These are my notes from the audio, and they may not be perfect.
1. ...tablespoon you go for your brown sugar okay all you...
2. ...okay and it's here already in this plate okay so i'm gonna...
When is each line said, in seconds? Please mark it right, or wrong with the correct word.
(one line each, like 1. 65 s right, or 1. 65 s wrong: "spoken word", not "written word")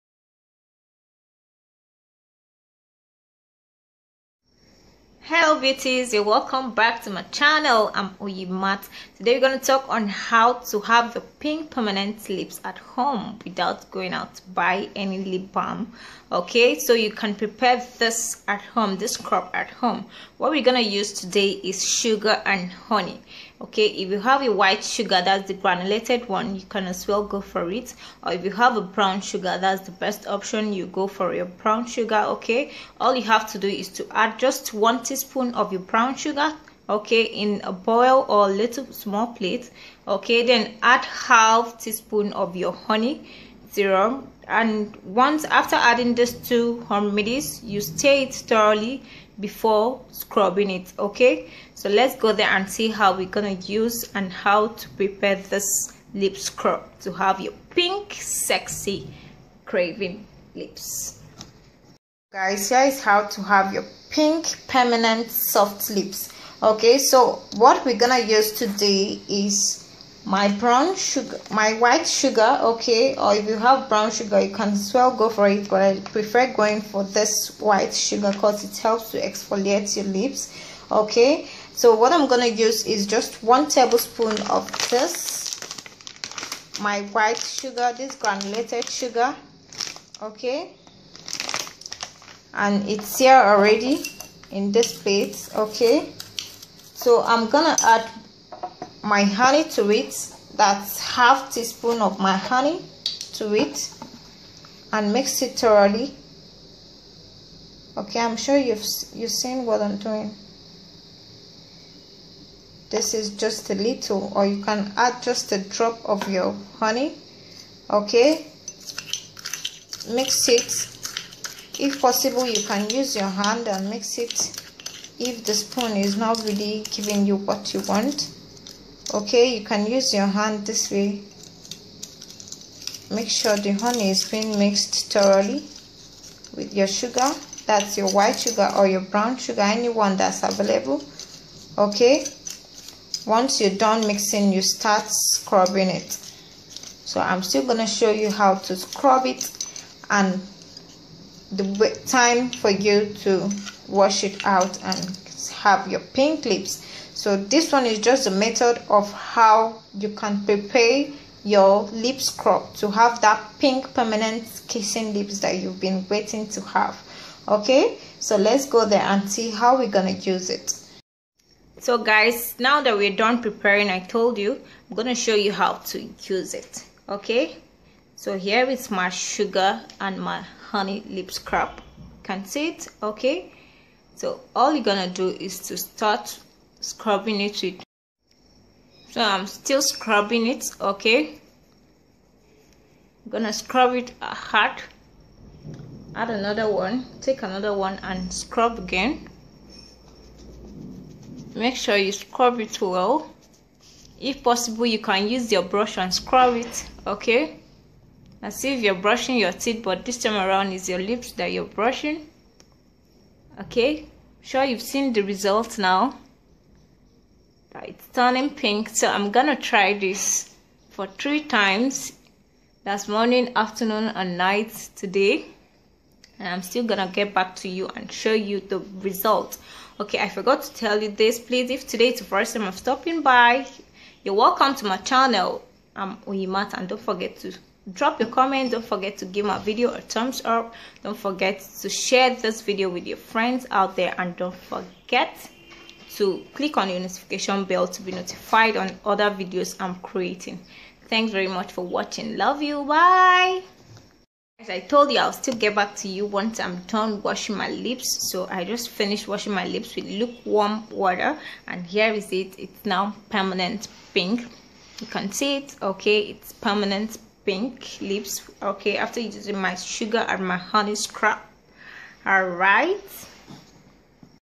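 1. 30 s wrong: "option", not "tablespoon"
2. 90 s right.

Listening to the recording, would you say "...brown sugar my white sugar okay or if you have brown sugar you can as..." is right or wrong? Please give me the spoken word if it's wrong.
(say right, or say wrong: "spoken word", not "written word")
right.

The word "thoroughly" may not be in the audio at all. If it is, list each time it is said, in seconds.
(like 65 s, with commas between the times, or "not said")
48 s, 105 s, 135 s.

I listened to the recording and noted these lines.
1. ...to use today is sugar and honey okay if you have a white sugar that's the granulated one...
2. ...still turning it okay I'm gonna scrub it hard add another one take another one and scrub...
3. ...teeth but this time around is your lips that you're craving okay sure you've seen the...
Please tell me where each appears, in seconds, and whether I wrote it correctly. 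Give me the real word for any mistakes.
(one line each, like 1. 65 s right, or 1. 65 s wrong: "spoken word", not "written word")
1. 20 s right
2. 189 s wrong: "scrubbing", not "turning"
3. 209 s wrong: "brushing", not "craving".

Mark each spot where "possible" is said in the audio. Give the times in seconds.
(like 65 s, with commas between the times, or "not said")
122 s, 204 s.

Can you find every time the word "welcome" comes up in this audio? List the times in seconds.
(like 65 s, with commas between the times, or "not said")
6 s, 234 s.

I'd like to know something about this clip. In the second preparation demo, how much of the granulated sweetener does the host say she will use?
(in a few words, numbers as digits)
1 tablespoon.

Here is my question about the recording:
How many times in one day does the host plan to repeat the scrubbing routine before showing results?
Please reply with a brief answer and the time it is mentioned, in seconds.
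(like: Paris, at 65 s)
3, at 221 s.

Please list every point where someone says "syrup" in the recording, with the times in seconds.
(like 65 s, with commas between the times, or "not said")
43 s.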